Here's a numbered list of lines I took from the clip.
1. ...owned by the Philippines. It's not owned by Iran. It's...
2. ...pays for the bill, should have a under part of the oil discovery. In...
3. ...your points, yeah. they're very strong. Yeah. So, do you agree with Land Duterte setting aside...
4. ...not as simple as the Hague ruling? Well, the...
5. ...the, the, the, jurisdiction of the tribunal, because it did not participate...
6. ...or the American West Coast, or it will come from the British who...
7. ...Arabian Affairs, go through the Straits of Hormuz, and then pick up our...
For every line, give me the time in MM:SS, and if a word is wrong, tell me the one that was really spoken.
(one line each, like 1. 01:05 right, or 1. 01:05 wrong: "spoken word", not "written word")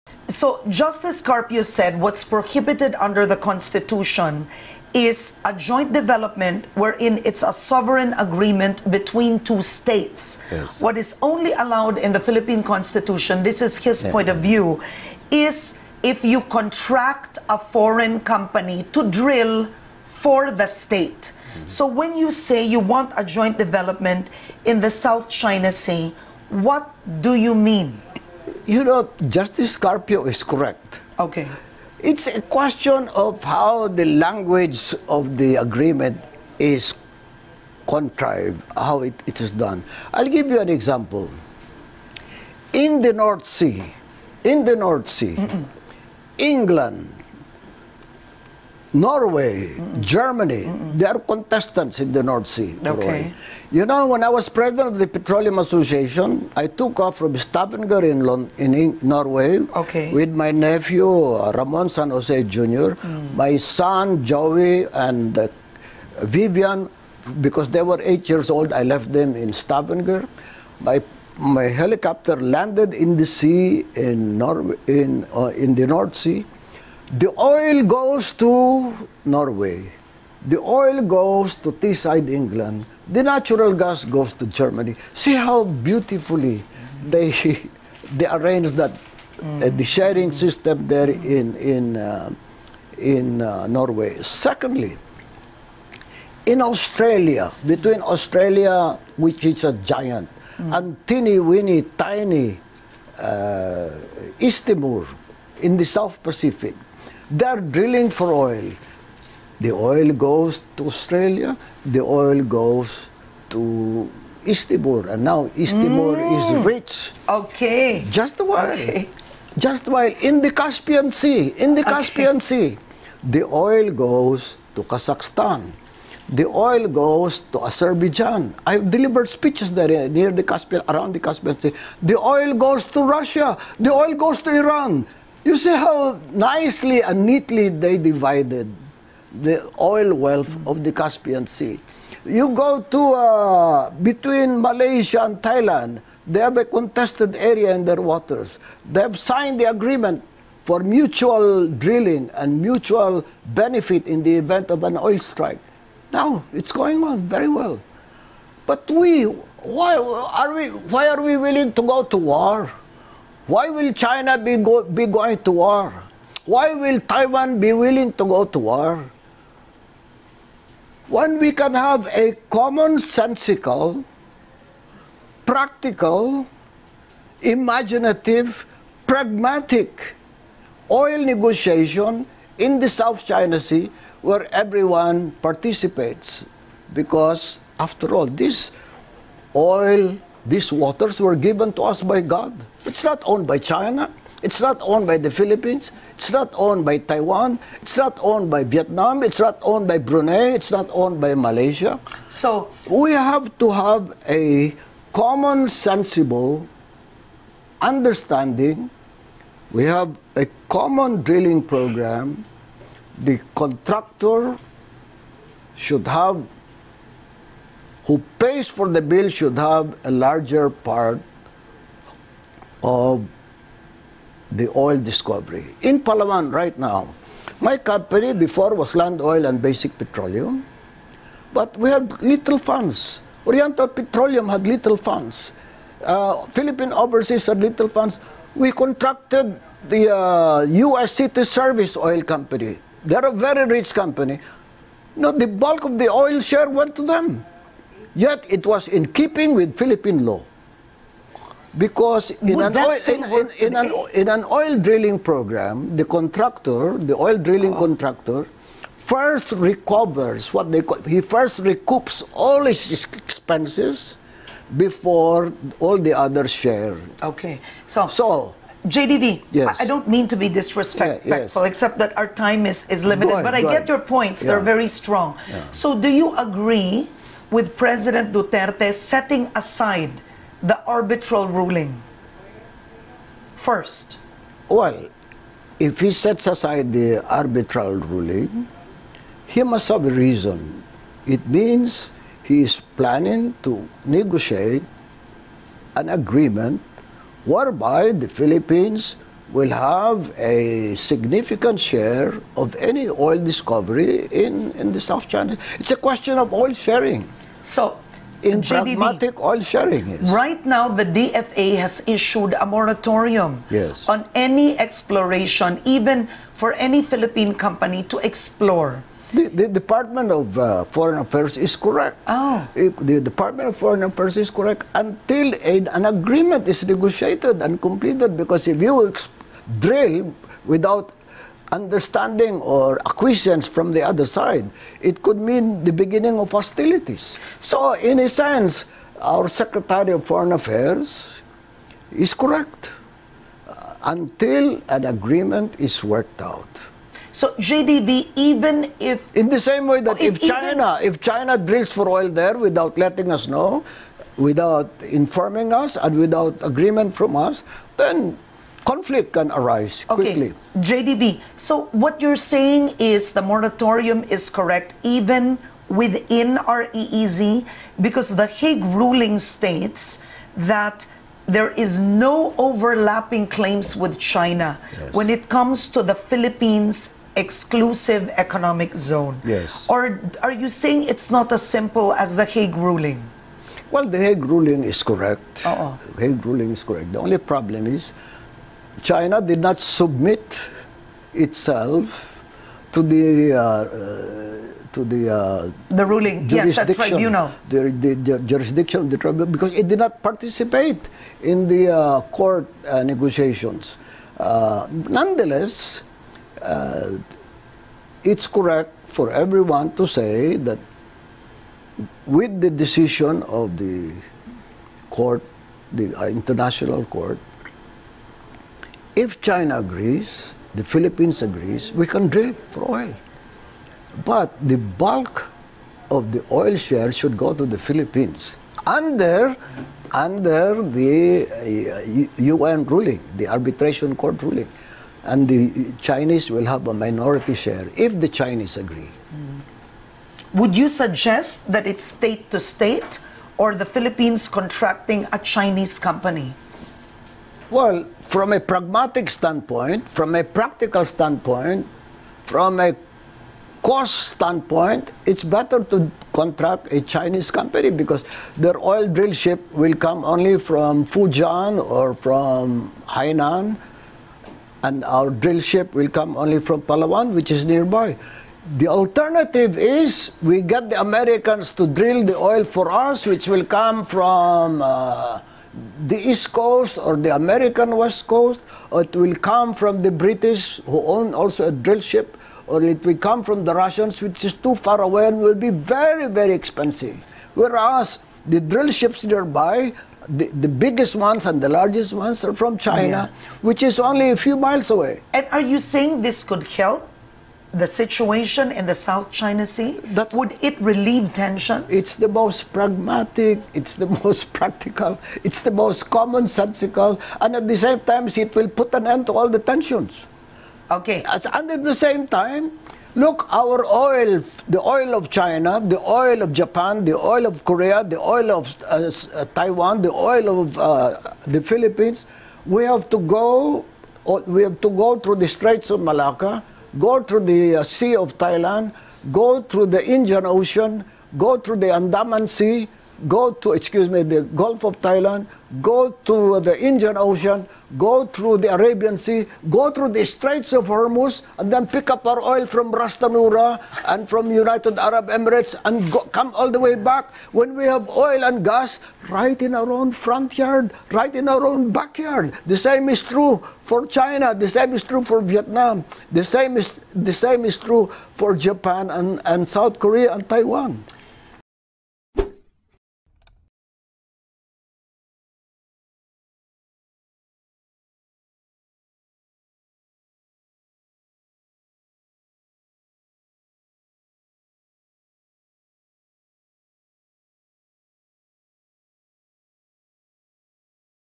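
1. 03:14 wrong: "Taiwan", not "Iran"
2. 03:38 wrong: "larger", not "under"
3. 04:33 wrong: "President", not "Land"
4. 06:21 right
5. 06:37 right
6. 07:56 right
7. 08:58 wrong: "Sea", not "Affairs".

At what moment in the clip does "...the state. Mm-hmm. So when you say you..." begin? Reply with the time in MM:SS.
00:20.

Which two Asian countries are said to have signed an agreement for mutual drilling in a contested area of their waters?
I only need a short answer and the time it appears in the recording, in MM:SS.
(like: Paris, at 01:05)
Malaysia and Thailand, at 02:24.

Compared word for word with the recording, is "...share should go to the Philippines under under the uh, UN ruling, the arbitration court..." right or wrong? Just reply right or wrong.
right.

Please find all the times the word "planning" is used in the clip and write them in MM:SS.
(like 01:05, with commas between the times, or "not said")
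04:52.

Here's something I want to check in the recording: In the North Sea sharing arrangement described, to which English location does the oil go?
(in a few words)
Teesside.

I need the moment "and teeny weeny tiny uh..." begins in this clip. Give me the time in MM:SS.
01:40.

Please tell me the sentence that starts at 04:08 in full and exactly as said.
Yet it was in keeping with Philippine law.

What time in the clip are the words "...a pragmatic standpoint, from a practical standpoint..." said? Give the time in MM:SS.
07:28.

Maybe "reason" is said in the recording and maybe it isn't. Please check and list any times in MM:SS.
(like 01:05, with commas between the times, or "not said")
04:50.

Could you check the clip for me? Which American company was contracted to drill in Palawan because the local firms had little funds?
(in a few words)
City Service Oil Company.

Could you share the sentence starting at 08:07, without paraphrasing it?
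Whereas the drill ships nearby, the, the biggest ones and the largest ones are from China, yeah.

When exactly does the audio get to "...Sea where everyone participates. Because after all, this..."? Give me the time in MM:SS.
03:03.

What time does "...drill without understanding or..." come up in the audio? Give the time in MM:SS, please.
05:29.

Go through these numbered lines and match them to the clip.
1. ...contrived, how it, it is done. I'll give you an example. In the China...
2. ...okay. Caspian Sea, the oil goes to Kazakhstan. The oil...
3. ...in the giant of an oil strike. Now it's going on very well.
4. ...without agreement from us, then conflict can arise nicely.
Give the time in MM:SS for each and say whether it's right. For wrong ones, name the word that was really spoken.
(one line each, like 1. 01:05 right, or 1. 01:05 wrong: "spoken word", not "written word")
1. 00:37 wrong: "North", not "China"
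2. 02:01 right
3. 02:34 wrong: "event", not "giant"
4. 05:56 wrong: "quickly", not "nicely".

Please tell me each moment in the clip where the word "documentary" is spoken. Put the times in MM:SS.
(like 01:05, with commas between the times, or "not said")
not said.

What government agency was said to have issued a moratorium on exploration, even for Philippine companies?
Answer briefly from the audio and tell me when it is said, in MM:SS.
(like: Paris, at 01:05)
Department of Foreign Affairs, at 05:19.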